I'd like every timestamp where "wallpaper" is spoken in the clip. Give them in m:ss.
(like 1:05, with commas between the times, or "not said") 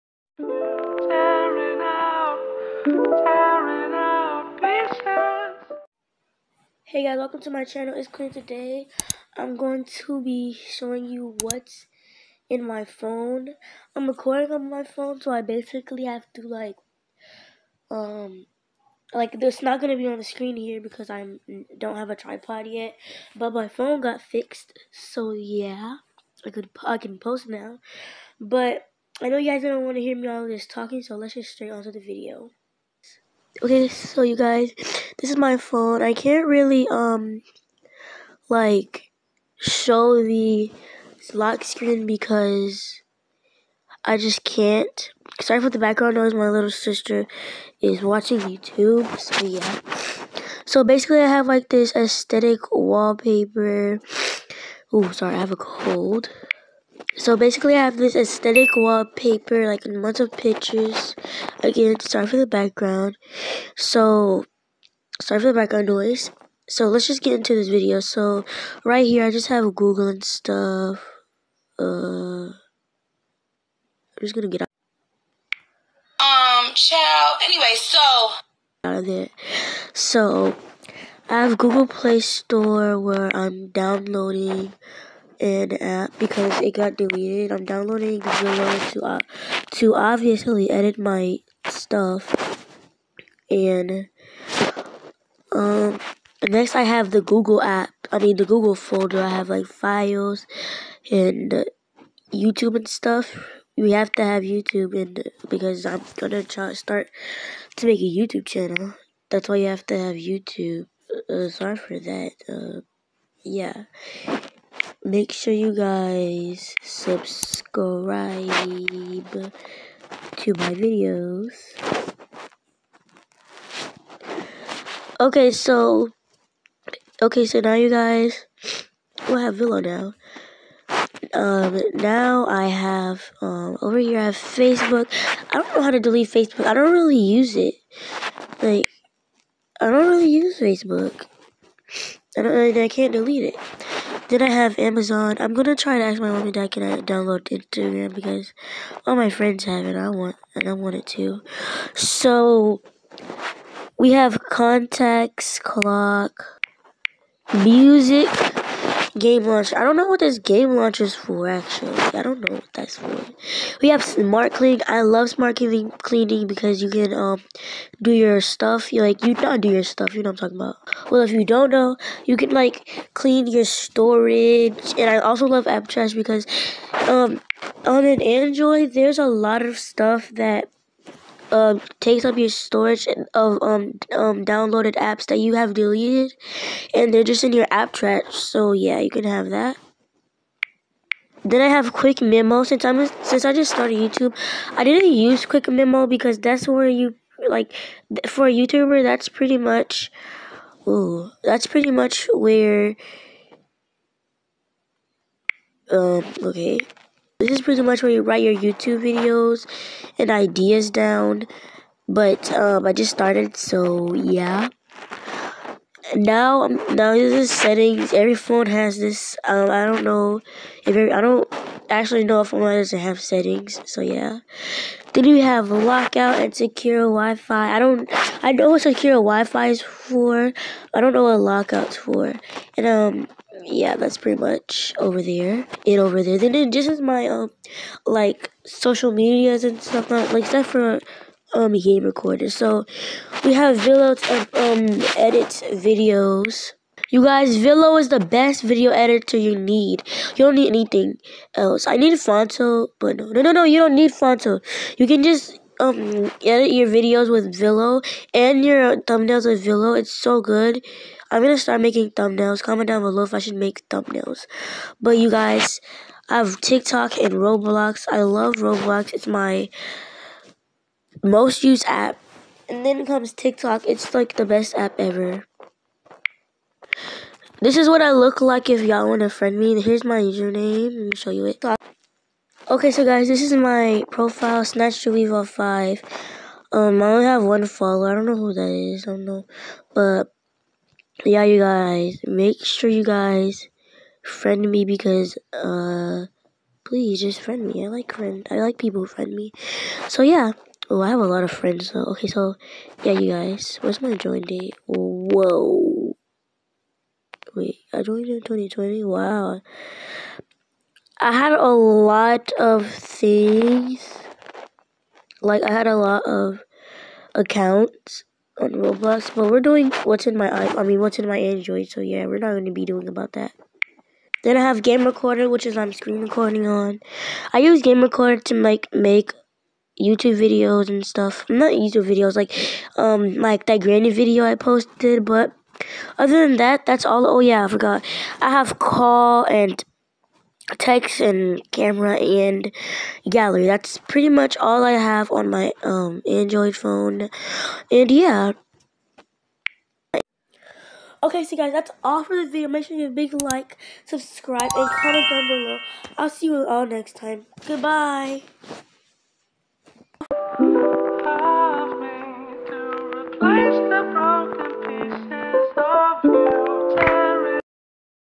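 0:52, 0:58.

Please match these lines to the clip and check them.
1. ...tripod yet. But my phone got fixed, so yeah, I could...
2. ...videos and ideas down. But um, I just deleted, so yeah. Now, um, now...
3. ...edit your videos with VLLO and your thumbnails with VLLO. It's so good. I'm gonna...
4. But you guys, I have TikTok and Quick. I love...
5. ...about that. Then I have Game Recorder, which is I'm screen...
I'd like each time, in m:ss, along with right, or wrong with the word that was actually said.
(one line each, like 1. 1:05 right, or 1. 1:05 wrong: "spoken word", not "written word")
1. 0:22 right
2. 3:29 wrong: "started", not "deleted"
3. 4:16 right
4. 4:25 wrong: "Roblox", not "Quick"
5. 5:23 right.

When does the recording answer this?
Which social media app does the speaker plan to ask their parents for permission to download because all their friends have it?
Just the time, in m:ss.
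2:27.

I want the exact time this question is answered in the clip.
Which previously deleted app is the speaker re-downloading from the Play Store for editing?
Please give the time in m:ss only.
1:28.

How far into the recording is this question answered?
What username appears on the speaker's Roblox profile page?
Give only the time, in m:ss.
4:44.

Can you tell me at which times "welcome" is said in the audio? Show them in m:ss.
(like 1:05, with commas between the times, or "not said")
0:07.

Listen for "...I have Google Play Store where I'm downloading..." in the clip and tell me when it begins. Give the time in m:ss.
1:21.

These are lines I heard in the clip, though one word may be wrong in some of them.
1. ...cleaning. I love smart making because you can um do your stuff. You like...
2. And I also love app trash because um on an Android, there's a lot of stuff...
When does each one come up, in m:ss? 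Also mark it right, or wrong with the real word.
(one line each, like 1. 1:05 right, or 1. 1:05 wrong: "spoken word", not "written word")
1. 2:44 wrong: "cleaning", not "making"
2. 2:54 right.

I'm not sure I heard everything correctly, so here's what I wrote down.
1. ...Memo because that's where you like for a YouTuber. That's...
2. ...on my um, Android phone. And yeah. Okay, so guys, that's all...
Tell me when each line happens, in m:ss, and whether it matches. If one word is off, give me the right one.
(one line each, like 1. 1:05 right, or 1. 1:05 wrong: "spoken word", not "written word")
1. 3:15 right
2. 5:45 right.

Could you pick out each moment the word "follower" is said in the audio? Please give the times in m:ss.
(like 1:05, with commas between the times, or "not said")
4:47.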